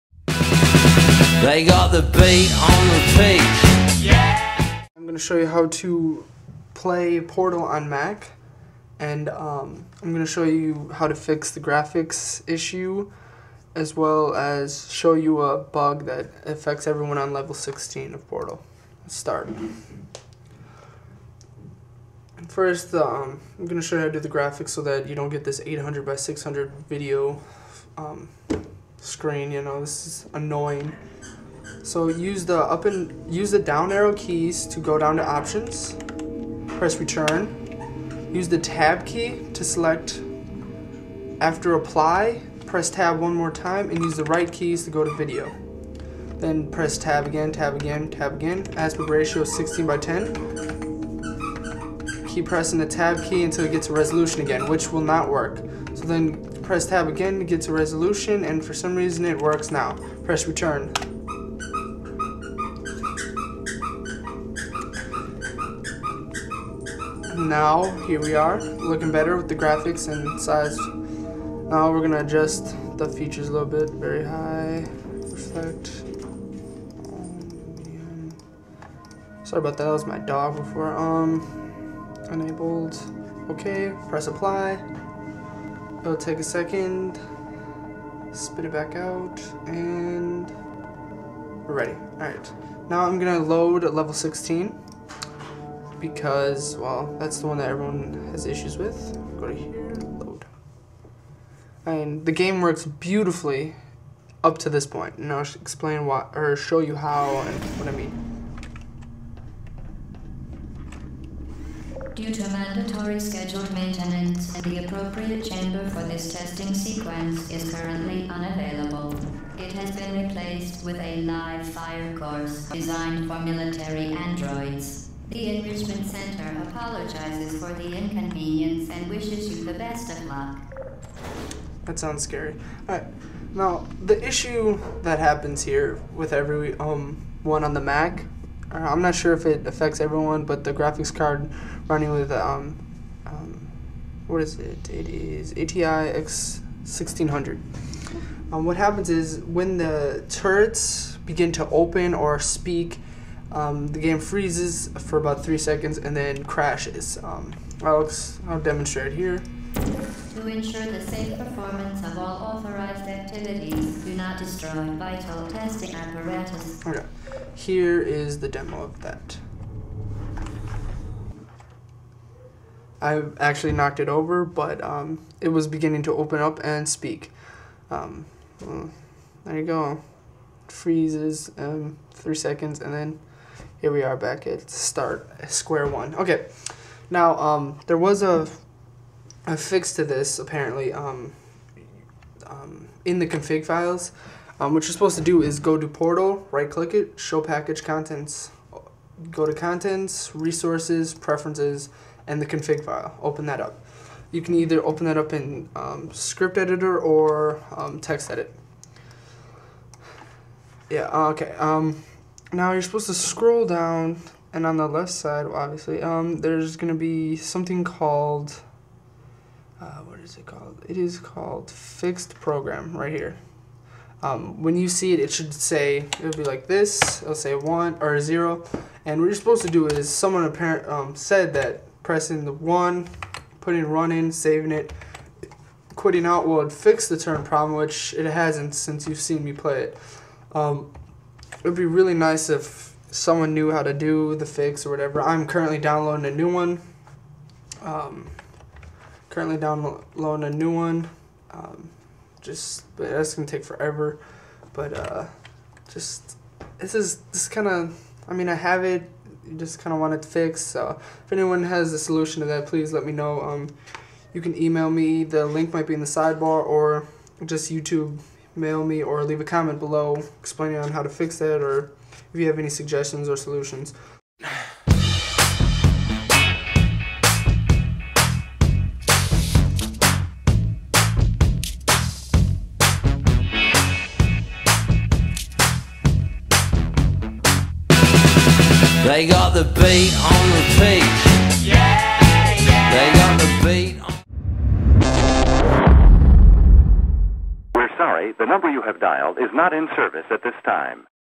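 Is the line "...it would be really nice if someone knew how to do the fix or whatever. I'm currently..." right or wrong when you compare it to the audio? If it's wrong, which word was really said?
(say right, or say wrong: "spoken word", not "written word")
right.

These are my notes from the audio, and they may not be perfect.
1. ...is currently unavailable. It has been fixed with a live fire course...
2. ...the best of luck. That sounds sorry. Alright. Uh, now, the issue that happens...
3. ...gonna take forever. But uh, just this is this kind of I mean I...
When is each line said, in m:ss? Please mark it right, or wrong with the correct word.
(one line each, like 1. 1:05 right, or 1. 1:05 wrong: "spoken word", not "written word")
1. 1:57 wrong: "replaced", not "fixed"
2. 2:09 wrong: "scary", not "sorry"
3. 4:13 right.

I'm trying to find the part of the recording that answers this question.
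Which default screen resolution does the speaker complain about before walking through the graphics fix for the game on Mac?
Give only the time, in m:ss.
0:25.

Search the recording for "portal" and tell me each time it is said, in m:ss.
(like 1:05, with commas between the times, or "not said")
0:07, 0:18, 3:15.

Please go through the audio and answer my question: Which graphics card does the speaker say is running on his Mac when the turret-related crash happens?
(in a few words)
ATI X1600.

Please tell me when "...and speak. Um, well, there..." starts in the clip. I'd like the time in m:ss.
2:56.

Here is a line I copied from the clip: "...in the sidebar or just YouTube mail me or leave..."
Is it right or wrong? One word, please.
right.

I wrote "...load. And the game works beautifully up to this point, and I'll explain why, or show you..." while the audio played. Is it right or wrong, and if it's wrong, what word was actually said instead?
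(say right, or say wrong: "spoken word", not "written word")
right.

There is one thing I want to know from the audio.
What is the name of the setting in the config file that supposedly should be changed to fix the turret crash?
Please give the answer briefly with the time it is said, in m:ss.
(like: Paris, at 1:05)
fixed program, at 3:41.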